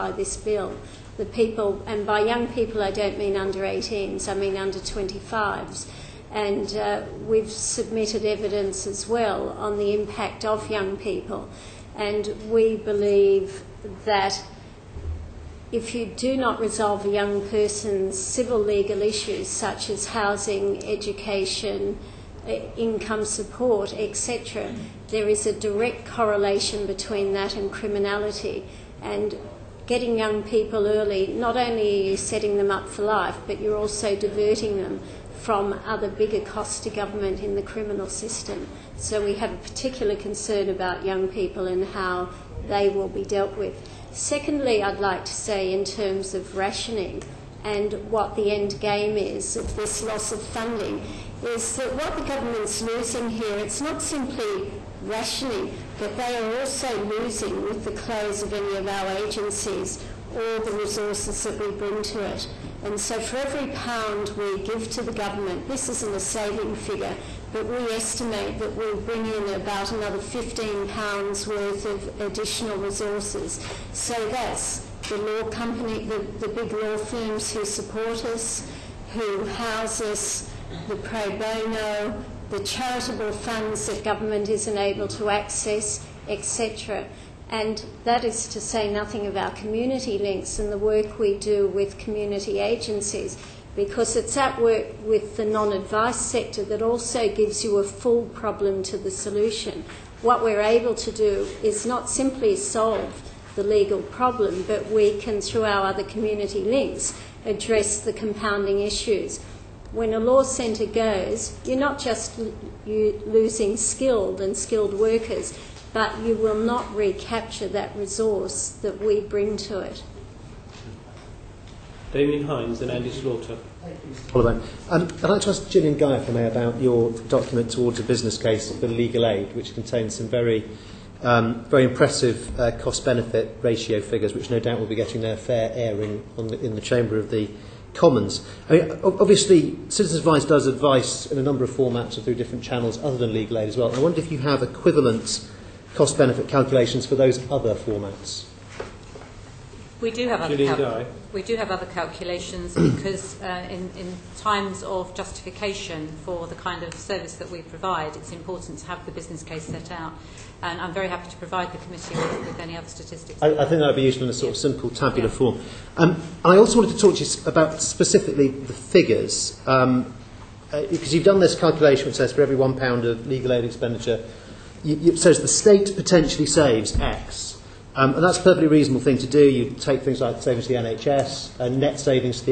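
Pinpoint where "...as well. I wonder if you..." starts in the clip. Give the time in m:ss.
2:23.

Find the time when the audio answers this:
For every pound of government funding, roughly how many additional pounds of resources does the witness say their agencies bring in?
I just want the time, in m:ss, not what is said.
1:10.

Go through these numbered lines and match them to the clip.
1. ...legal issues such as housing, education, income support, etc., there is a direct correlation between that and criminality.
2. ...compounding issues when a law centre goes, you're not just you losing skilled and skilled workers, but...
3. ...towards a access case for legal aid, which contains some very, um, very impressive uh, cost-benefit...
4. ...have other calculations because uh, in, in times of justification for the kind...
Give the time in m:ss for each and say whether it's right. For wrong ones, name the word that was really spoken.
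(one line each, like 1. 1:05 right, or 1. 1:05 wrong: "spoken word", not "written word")
1. 0:18 right
2. 1:48 right
3. 2:07 wrong: "business", not "access"
4. 2:31 right.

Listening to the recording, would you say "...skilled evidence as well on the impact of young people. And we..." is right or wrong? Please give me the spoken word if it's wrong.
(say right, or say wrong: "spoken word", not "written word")
wrong: "submitted", not "skilled".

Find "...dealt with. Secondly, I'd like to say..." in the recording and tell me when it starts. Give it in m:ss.
0:43.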